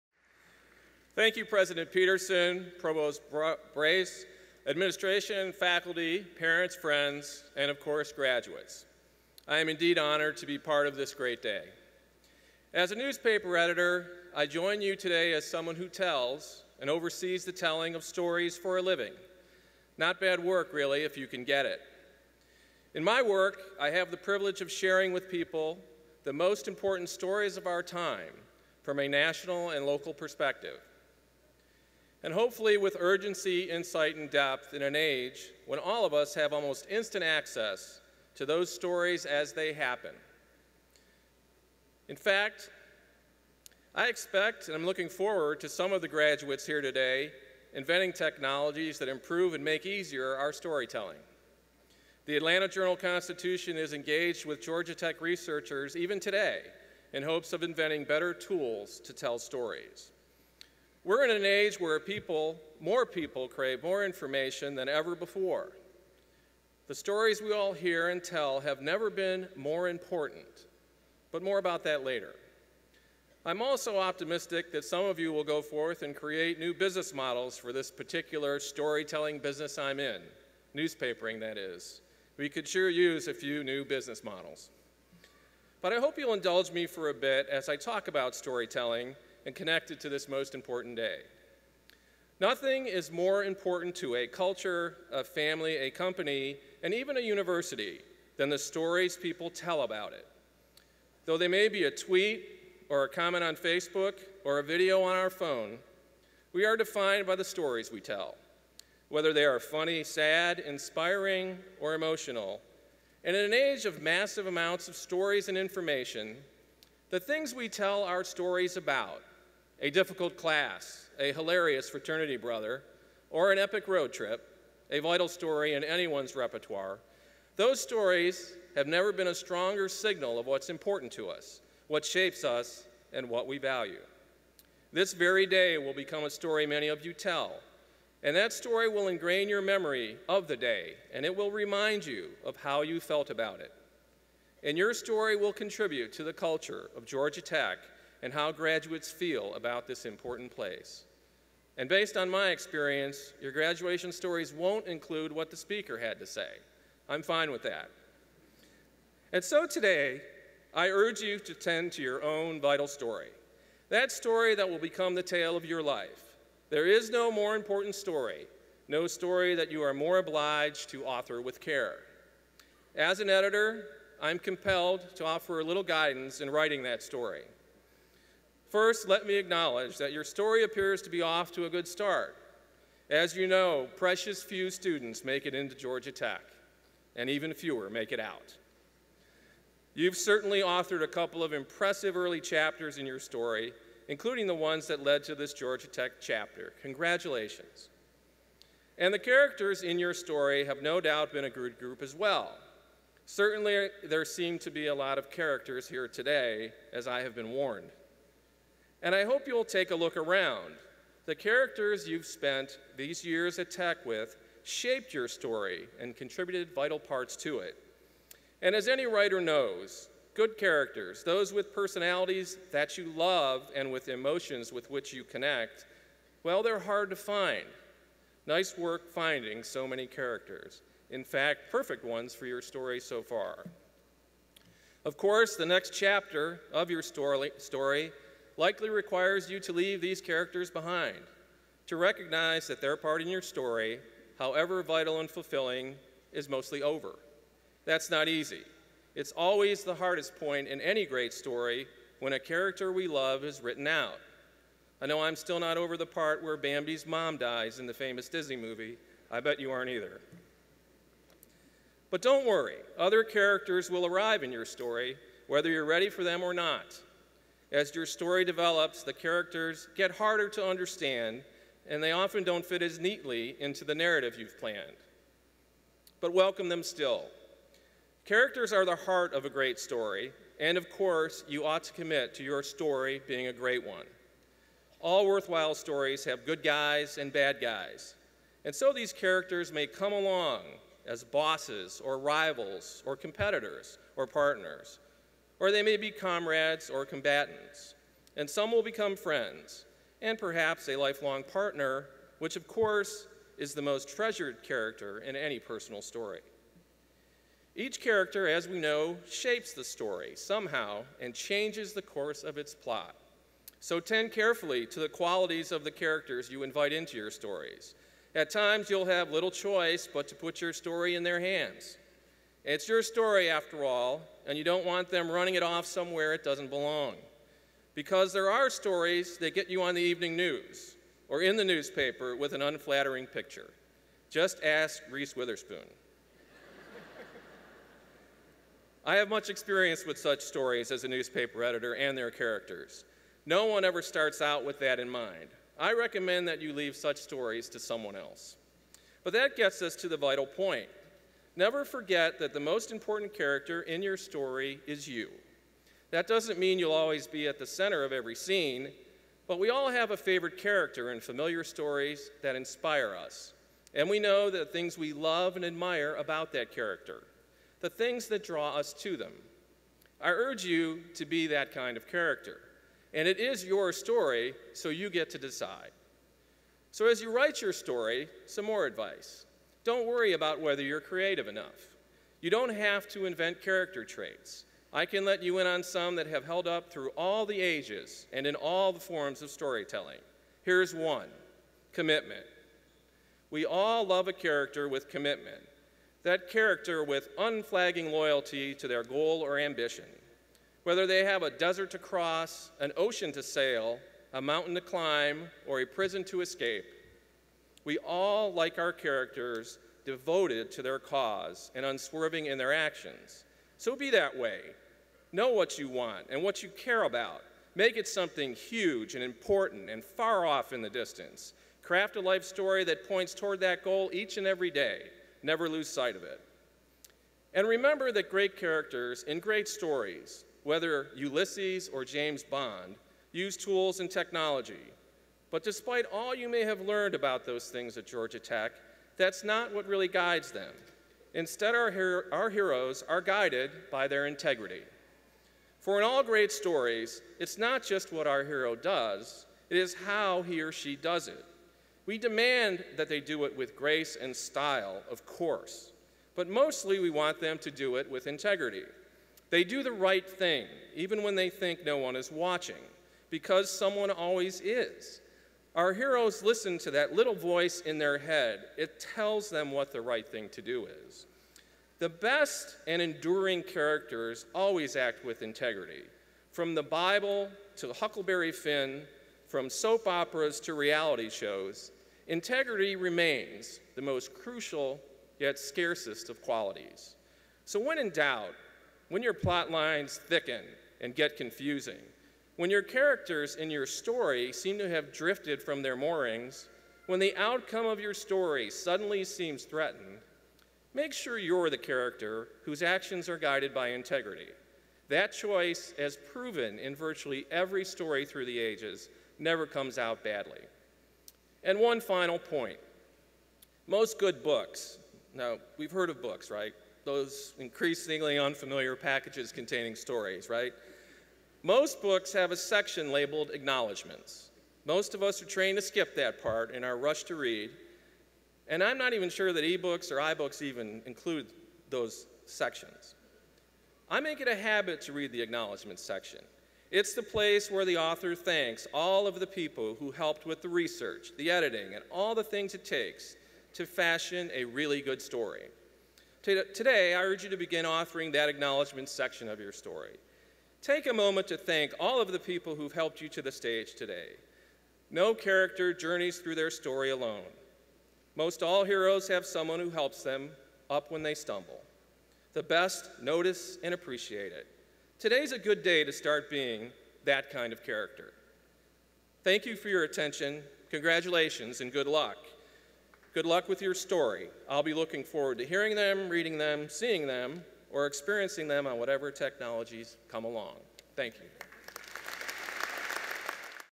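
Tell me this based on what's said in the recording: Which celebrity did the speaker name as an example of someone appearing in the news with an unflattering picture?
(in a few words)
Reese Witherspoon.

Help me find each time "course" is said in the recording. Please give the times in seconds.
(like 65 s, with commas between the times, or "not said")
7 s, 235 s, 280 s, 302 s, 312 s, 455 s.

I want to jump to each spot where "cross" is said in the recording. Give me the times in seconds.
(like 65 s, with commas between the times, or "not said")
401 s.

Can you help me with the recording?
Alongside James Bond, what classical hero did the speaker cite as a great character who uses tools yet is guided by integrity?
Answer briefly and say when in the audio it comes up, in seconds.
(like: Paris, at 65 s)
Ulysses, at 431 s.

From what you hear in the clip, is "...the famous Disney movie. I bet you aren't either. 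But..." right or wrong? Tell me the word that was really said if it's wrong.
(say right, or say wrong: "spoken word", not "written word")
right.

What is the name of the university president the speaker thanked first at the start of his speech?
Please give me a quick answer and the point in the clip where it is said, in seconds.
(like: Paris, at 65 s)
Peterson, at 1 s.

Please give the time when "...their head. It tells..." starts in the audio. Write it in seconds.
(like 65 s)
467 s.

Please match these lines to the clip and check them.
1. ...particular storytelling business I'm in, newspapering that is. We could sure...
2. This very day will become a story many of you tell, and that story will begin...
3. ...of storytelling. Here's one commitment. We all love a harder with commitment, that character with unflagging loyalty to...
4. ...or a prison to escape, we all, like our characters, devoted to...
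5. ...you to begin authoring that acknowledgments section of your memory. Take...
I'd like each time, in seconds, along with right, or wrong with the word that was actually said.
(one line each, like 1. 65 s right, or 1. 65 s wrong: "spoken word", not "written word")
1. 77 s right
2. 134 s wrong: "ingrain", not "begin"
3. 389 s wrong: "character", not "harder"
4. 405 s right
5. 547 s wrong: "story", not "memory".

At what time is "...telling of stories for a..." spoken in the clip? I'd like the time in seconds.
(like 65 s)
17 s.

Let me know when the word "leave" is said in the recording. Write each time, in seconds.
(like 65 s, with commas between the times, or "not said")
239 s, 346 s.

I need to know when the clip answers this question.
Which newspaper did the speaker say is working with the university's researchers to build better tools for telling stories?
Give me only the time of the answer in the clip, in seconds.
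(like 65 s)
52 s.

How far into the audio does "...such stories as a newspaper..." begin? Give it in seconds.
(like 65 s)
340 s.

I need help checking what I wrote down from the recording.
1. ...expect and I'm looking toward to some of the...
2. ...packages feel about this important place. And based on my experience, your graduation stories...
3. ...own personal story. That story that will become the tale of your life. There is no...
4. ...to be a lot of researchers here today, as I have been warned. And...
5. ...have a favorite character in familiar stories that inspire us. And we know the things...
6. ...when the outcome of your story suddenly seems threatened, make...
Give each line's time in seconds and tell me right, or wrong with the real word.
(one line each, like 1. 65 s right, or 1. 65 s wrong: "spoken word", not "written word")
1. 44 s wrong: "forward", not "toward"
2. 148 s wrong: "graduates", not "packages"
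3. 162 s wrong: "vital", not "personal"
4. 204 s wrong: "characters", not "researchers"
5. 359 s right
6. 497 s right.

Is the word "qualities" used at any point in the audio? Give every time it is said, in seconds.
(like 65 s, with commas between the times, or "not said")
315 s, 486 s.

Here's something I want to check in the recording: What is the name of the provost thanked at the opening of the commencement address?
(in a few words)
Bras.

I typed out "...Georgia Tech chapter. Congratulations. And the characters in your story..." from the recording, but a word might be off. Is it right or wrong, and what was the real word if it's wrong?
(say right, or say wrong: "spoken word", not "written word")
right.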